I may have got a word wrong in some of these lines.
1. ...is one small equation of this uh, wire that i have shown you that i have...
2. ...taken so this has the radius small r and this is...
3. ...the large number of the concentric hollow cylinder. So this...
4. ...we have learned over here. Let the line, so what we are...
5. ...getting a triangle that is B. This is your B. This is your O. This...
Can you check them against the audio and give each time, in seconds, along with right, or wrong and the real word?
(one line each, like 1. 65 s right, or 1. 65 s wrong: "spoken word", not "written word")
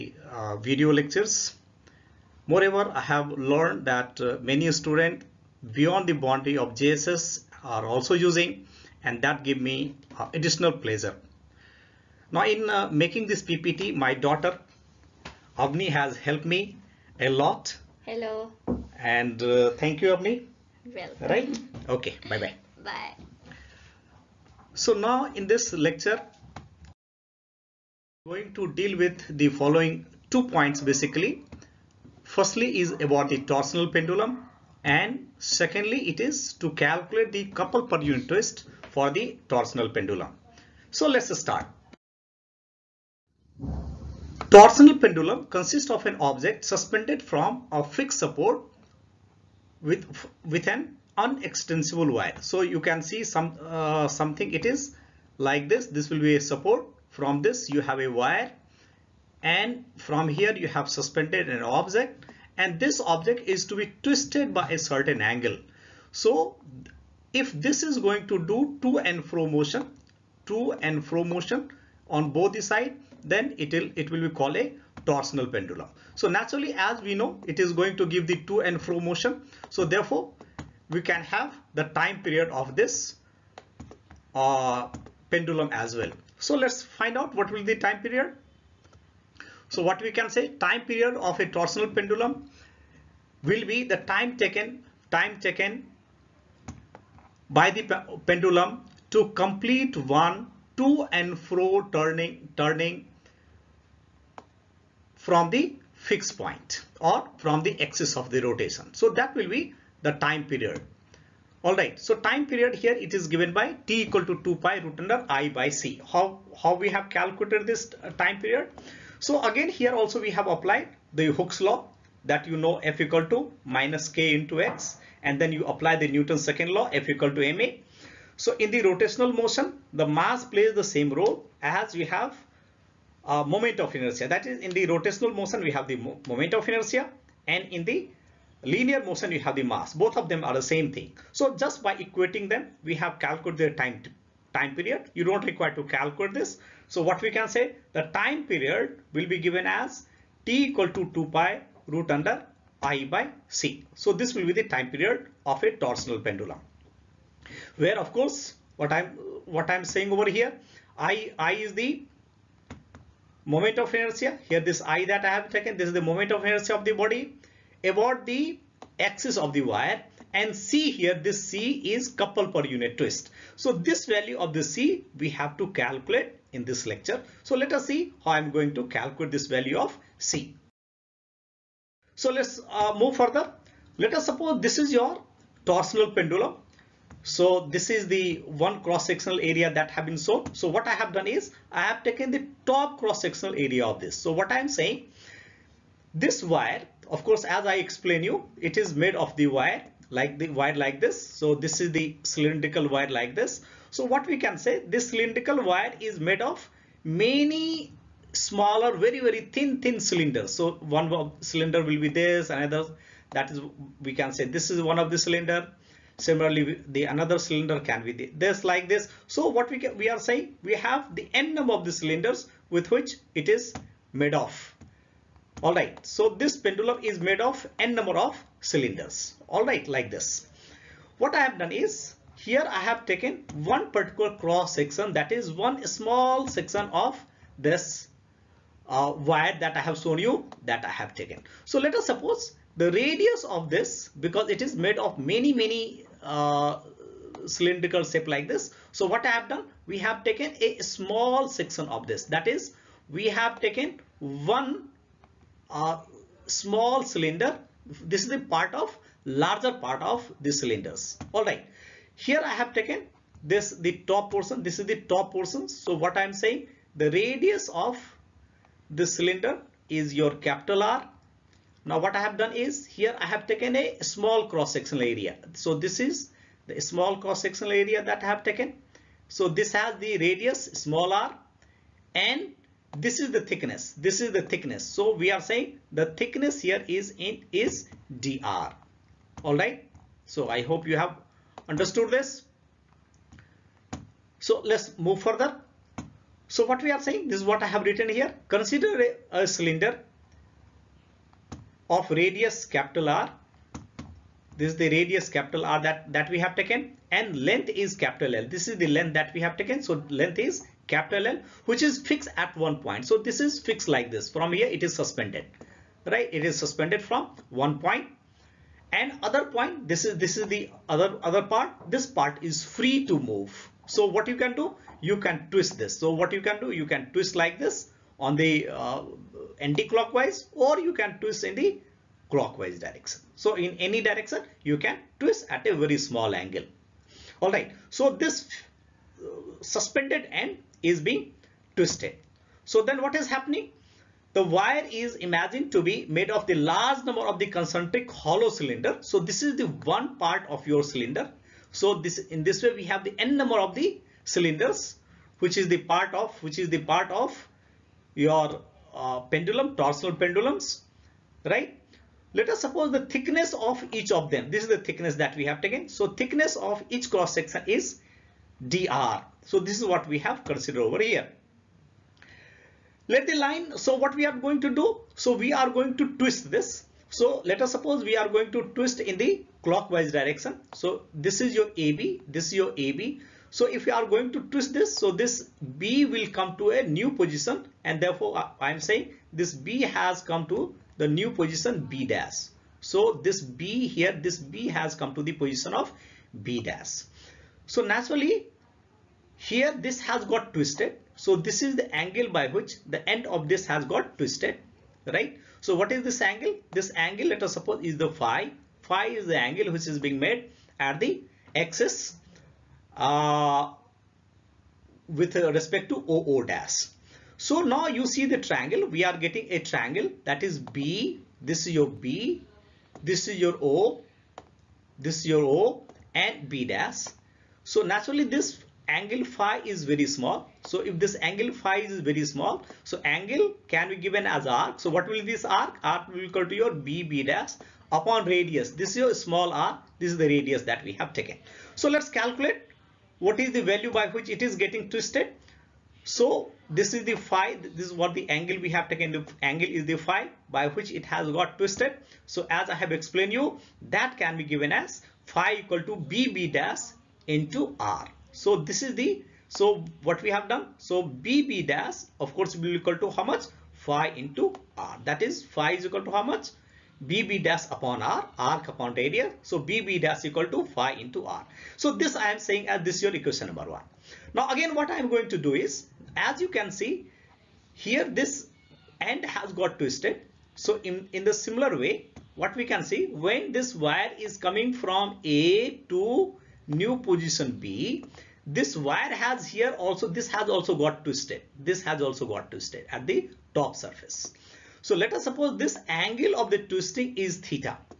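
1. 235 s wrong: "section", not "equation"
2. 278 s right
3. 346 s right
4. 370 s wrong: "considered", not "learned"
5. 419 s right.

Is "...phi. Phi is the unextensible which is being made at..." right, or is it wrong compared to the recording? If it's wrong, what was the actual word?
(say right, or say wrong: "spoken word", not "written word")
wrong: "angle", not "unextensible".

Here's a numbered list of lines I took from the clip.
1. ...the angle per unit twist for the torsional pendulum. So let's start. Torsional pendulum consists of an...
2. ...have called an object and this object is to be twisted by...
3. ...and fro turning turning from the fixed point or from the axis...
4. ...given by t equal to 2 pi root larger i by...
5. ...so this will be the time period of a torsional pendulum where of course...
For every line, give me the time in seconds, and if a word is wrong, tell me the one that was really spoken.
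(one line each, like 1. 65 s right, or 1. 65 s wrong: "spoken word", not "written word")
1. 37 s wrong: "couple", not "angle"
2. 60 s wrong: "suspended", not "called"
3. 101 s right
4. 113 s wrong: "under", not "larger"
5. 153 s right.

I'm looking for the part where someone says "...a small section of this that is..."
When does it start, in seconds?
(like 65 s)
250 s.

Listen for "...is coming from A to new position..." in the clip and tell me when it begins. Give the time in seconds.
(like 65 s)
484 s.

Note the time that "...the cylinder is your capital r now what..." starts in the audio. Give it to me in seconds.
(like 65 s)
268 s.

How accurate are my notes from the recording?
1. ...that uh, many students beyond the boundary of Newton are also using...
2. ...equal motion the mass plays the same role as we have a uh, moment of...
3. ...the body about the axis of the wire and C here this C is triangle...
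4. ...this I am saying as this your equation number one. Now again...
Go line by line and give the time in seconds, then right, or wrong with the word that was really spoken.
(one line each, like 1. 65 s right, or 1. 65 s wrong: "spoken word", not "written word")
1. 3 s wrong: "JSS", not "Newton"
2. 128 s wrong: "rotational", not "equal"
3. 166 s wrong: "couple", not "triangle"
4. 471 s right.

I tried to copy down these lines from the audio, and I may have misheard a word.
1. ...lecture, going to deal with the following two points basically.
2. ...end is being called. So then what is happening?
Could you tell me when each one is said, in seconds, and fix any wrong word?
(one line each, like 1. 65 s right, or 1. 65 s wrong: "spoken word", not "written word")
1. 25 s right
2. 340 s wrong: "twisted", not "called".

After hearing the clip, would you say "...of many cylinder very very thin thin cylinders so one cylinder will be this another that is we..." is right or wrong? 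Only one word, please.
wrong.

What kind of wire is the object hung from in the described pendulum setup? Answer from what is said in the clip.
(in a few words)
unextensible wire.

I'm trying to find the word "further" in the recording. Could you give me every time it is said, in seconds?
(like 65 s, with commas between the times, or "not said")
183 s, 295 s.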